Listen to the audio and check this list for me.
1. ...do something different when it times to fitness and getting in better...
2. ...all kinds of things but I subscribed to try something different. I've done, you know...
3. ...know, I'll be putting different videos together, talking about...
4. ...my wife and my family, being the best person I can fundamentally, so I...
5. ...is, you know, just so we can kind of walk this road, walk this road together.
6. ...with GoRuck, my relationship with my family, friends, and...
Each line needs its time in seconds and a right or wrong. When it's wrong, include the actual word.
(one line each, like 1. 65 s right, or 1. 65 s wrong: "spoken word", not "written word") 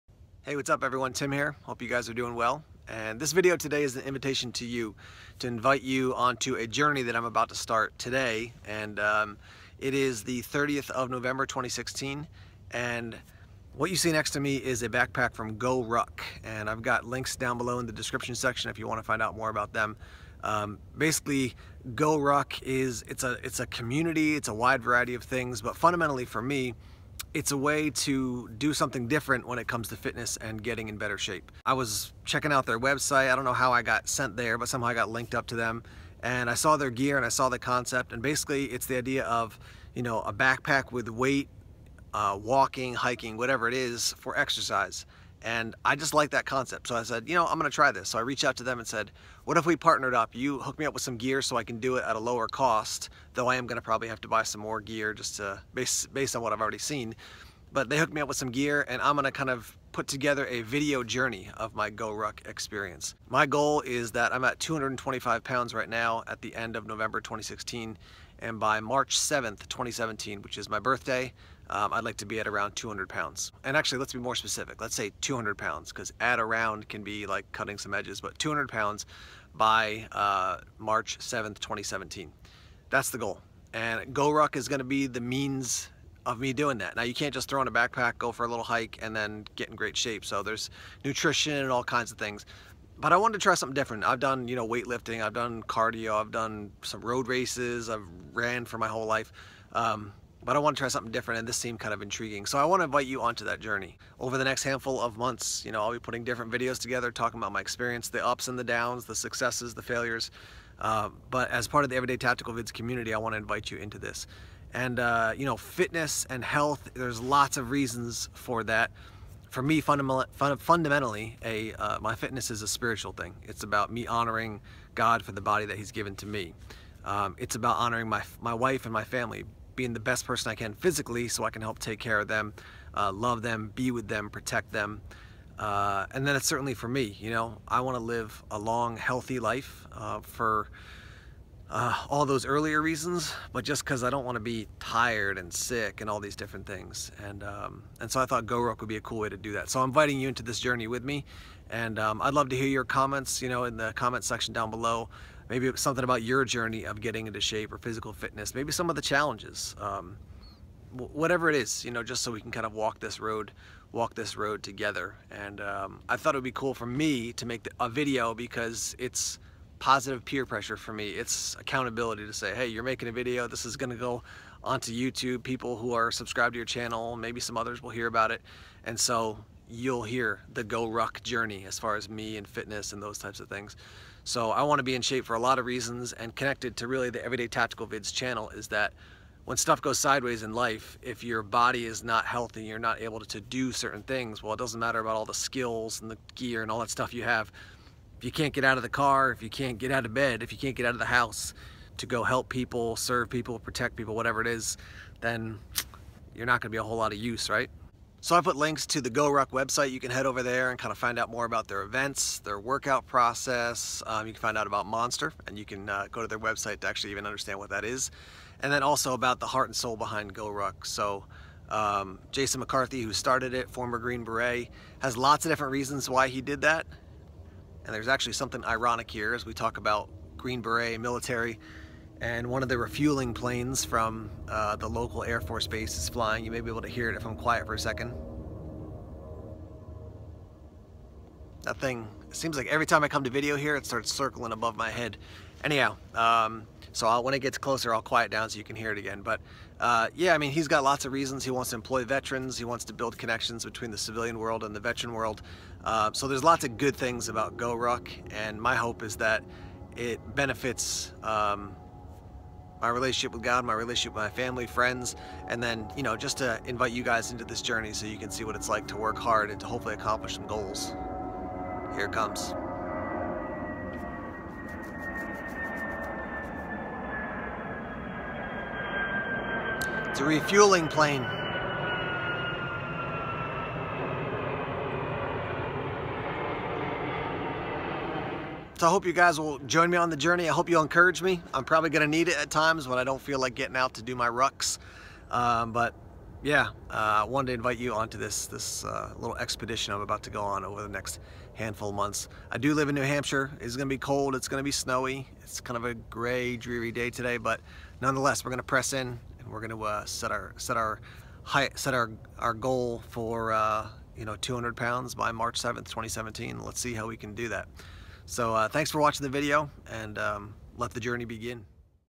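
1. 28 s wrong: "comes", not "times"
2. 91 s wrong: "wanted", not "subscribed"
3. 105 s right
4. 128 s wrong: "physically", not "fundamentally"
5. 161 s right
6. 263 s wrong: "God", not "GoRuck".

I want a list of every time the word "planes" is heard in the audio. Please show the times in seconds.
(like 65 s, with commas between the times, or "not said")
233 s, 280 s.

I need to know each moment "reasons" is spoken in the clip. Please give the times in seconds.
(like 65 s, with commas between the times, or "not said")
117 s, 142 s, 185 s, 225 s, 251 s.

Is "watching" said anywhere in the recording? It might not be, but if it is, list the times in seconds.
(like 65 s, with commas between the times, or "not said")
319 s.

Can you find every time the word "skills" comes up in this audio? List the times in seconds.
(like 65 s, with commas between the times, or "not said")
195 s.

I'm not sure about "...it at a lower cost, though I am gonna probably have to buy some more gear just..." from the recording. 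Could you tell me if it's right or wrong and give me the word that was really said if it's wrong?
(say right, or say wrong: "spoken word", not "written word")
right.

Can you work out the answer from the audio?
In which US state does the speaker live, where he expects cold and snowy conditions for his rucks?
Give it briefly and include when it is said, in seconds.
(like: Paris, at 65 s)
New Hampshire, at 302 s.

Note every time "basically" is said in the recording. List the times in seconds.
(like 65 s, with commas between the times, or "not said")
20 s, 38 s.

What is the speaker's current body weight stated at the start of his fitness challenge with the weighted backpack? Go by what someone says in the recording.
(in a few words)
225 pounds.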